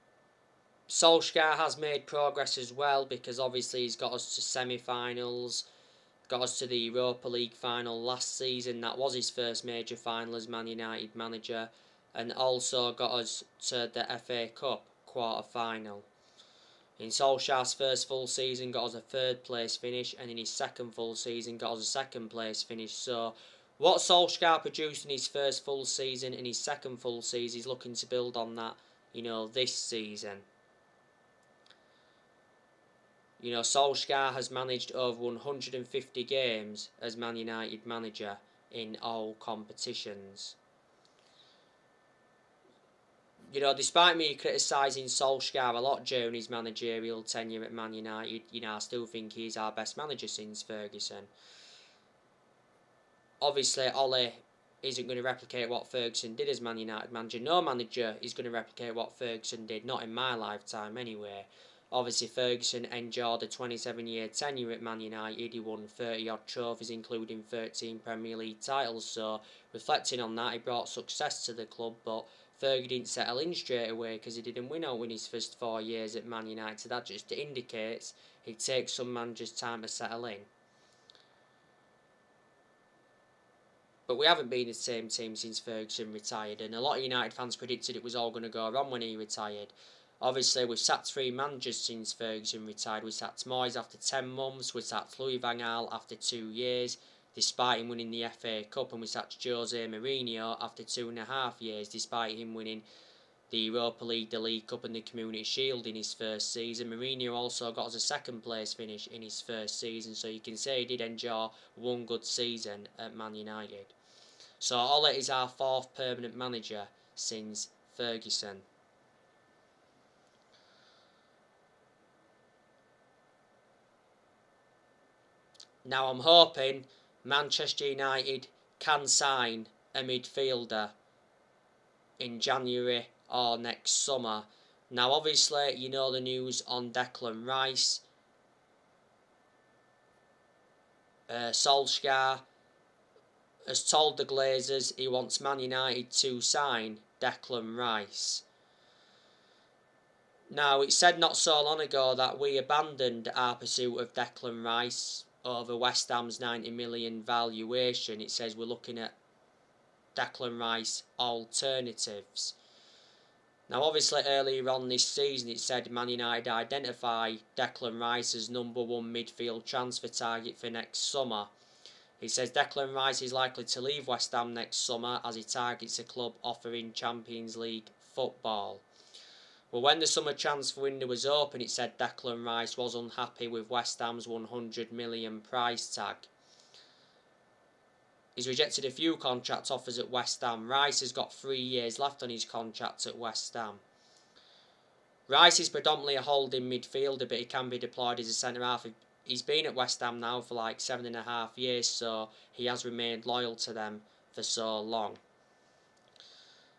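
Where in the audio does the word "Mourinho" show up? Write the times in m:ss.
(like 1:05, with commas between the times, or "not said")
1:39, 1:46.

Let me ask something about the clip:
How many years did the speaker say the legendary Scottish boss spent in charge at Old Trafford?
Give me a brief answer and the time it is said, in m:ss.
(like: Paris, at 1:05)
27, at 1:03.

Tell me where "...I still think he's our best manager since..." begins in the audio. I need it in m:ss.
0:48.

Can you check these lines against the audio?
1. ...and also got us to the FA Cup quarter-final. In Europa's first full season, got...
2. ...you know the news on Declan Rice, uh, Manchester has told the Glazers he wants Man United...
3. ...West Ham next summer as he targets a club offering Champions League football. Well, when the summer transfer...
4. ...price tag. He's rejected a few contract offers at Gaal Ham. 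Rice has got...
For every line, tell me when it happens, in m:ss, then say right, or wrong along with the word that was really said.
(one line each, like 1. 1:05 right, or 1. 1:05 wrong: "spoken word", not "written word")
1. 0:12 wrong: "Solskjaer", not "Europa"
2. 2:15 wrong: "Solskjaer", not "Manchester"
3. 2:54 right
4. 3:05 wrong: "West", not "Gaal".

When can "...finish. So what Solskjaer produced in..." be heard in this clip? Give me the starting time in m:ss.
0:22.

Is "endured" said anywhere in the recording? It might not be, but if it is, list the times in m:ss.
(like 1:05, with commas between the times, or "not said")
1:02.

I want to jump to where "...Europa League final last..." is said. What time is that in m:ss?
0:06.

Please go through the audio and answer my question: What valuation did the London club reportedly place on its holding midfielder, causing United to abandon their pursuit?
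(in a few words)
90 million.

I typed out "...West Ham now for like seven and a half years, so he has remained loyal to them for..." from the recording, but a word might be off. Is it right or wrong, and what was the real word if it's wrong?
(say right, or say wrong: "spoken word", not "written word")
right.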